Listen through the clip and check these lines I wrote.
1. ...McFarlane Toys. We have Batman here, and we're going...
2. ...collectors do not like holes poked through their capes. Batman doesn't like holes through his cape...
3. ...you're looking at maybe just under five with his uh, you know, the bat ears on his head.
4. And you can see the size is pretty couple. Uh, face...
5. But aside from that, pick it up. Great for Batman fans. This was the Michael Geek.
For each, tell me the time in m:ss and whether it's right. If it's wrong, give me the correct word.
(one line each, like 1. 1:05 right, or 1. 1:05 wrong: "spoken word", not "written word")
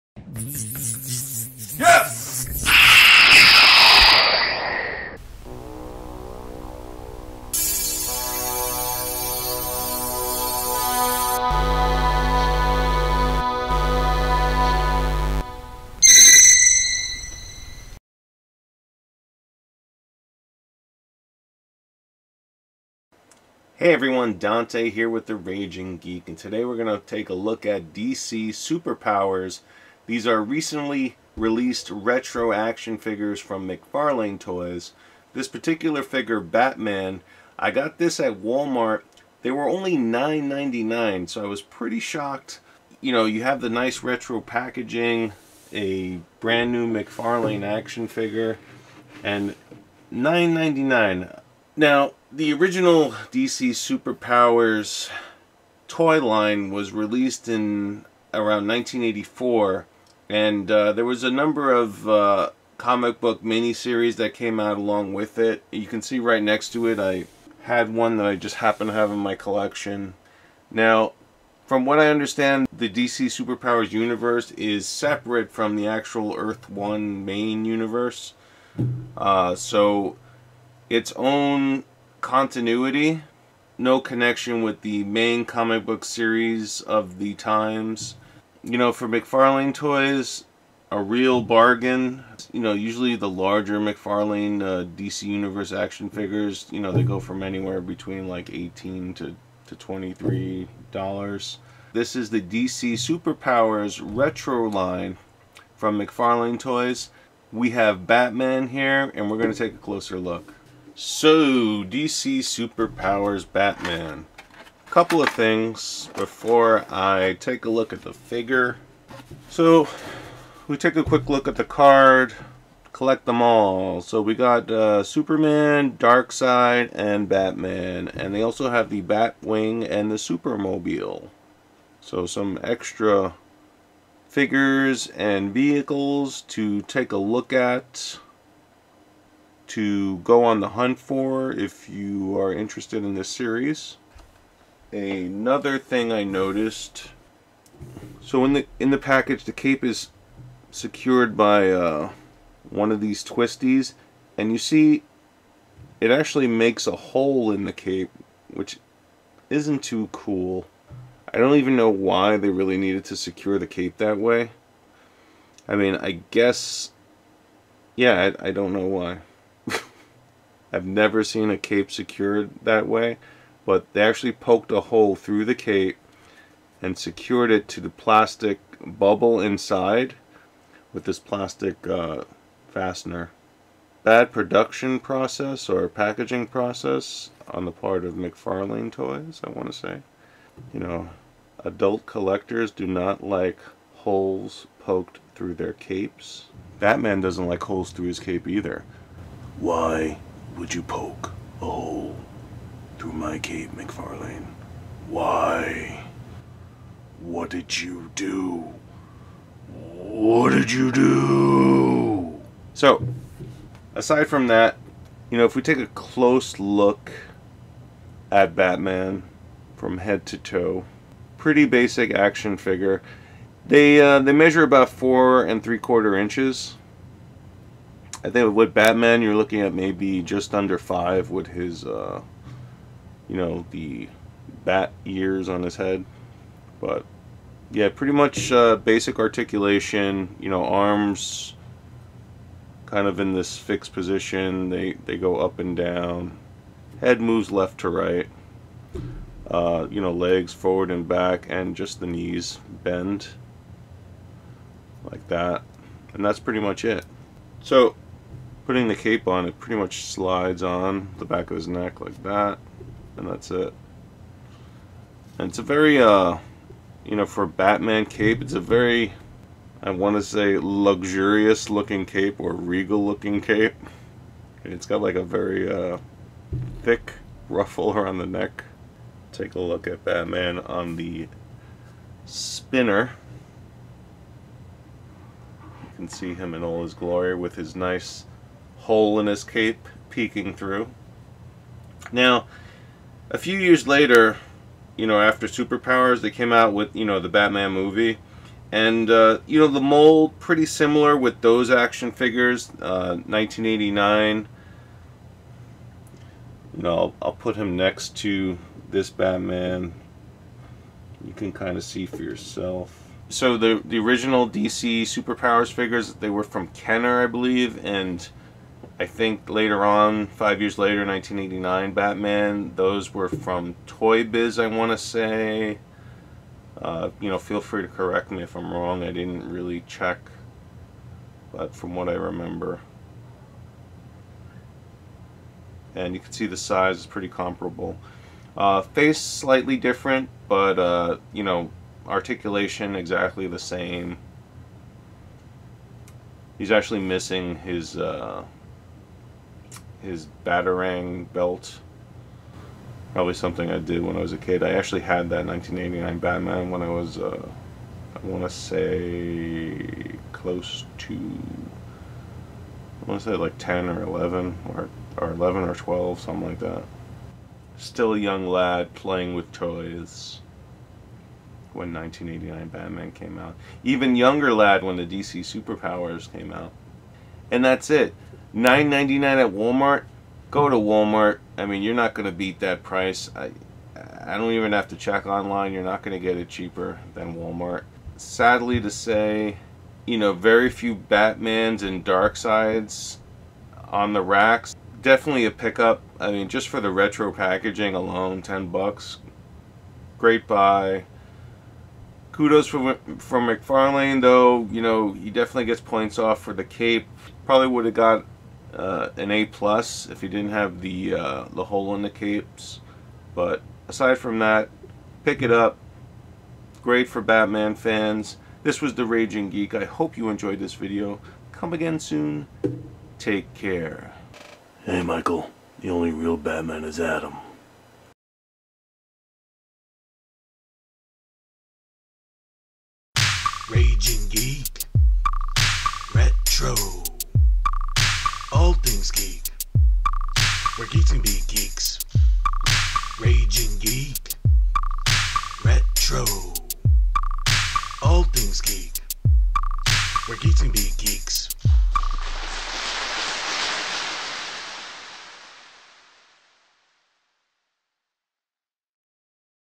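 1. 1:45 right
2. 3:12 right
3. 3:49 right
4. 5:35 wrong: "comparable", not "couple"
5. 6:53 wrong: "Raging", not "Michael".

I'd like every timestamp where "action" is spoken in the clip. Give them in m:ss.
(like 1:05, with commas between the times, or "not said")
0:32, 0:47, 1:35, 3:42, 5:01.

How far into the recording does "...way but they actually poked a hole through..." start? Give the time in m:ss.
2:52.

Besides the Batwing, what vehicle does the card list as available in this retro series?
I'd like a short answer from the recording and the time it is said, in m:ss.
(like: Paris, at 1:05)
Supermobile, at 2:10.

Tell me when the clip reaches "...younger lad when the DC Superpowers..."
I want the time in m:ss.
6:14.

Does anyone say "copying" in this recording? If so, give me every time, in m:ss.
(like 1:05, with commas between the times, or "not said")
not said.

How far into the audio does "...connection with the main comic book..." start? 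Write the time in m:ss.
1:23.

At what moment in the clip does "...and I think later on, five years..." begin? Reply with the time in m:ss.
5:17.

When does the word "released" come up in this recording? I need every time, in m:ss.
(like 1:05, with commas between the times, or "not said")
0:31, 0:56.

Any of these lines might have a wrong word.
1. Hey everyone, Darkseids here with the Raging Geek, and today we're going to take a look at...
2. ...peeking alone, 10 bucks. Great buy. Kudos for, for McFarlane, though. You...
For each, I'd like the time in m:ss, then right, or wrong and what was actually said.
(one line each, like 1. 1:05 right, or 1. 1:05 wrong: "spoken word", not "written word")
1. 0:23 wrong: "Dante", not "Darkseids"
2. 6:37 wrong: "packaging", not "peeking".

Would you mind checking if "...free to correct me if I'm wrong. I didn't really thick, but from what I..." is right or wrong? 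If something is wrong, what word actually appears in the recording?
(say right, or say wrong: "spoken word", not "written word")
wrong: "check", not "thick".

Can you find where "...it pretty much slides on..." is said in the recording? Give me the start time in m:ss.
4:19.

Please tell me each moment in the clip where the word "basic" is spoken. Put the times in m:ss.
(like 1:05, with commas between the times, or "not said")
3:41, 3:58.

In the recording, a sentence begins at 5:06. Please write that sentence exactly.
You know, I'll, I'll put him next to this Batman.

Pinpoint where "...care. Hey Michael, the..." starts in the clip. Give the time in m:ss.
7:03.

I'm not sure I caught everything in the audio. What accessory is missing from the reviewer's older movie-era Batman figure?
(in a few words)
batarang belt.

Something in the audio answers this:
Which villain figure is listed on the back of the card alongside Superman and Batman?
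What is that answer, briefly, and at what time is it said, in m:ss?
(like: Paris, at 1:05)
Darkseid, at 2:05.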